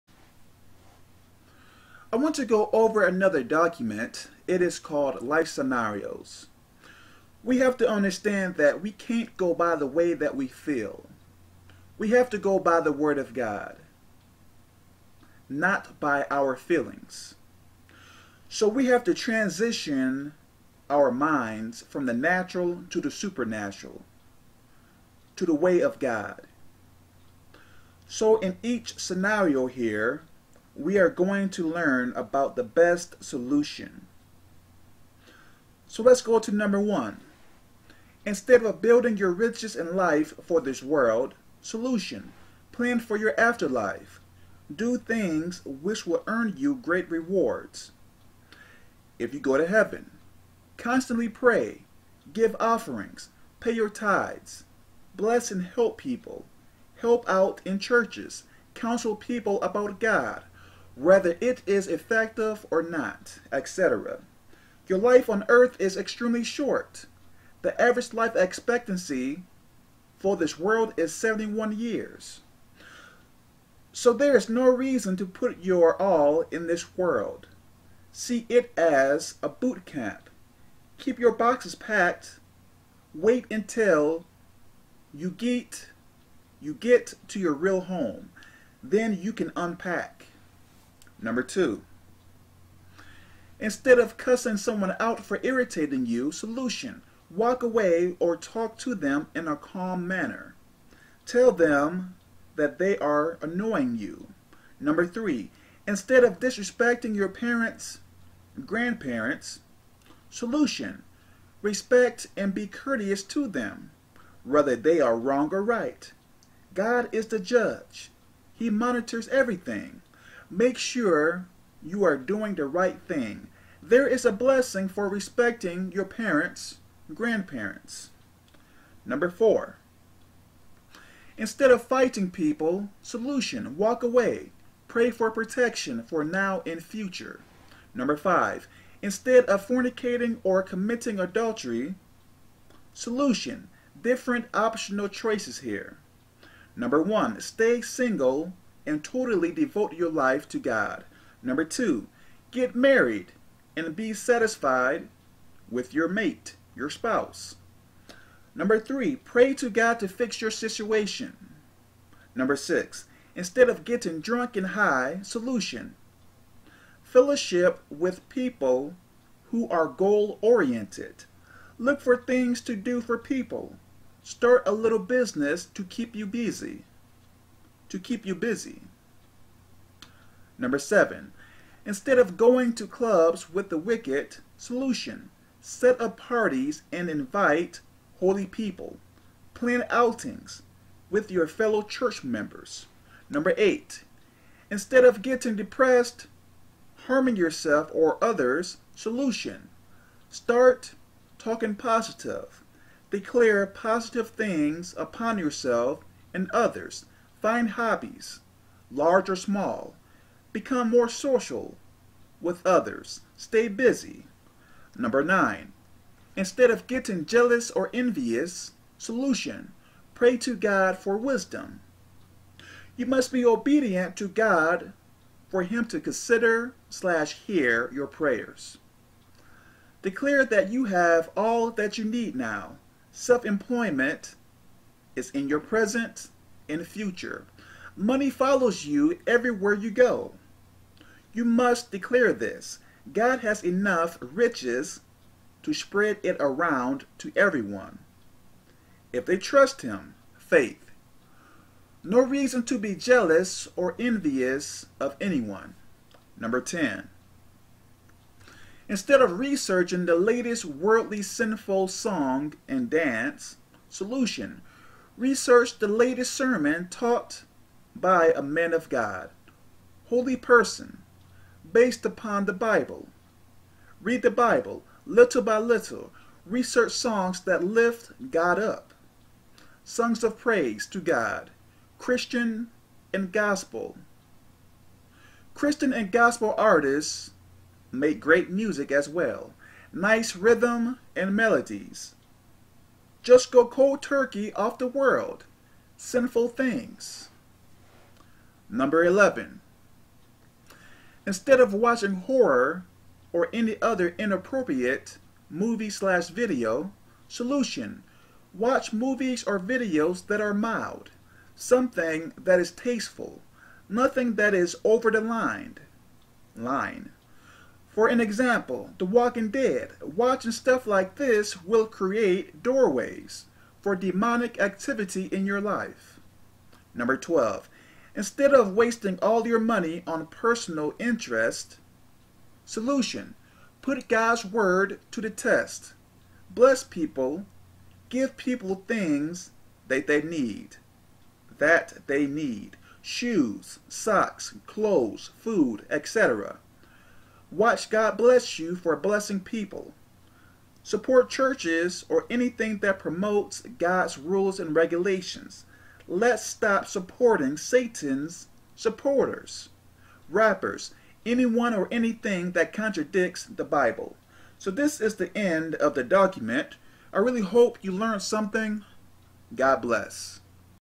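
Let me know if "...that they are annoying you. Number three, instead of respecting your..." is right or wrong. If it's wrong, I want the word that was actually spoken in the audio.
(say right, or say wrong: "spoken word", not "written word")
wrong: "disrespecting", not "respecting".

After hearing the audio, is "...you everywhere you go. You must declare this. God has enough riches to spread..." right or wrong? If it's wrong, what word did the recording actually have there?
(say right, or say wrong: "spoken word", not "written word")
right.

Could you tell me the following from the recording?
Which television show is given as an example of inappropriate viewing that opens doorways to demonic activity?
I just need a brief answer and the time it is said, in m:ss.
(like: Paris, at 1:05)
The Walking Dead, at 5:18.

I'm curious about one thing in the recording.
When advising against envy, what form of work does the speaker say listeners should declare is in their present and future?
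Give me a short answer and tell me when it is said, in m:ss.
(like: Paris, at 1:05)
Self-employment, at 3:53.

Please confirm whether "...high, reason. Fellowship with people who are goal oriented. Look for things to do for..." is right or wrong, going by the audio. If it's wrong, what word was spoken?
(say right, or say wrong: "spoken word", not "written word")
wrong: "solution", not "reason".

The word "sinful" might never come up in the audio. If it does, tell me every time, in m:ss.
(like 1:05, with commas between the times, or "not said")
4:21, 4:55.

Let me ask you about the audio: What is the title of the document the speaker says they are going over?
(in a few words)
Life Scenarios.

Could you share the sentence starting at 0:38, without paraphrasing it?
Instead of building your riches in life for this world, solution, plan for your afterlife.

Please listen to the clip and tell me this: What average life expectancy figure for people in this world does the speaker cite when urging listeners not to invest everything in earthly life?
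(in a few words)
71 years.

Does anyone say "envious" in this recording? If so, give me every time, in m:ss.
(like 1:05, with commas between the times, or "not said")
3:37, 4:13.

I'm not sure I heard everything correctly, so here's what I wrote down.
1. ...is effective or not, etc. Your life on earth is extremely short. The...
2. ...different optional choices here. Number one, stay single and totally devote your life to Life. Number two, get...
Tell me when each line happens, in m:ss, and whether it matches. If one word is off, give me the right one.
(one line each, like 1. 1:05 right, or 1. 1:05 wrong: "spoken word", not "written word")
1. 1:01 right
2. 2:24 wrong: "God", not "Life".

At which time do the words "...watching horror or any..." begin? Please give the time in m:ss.
5:01.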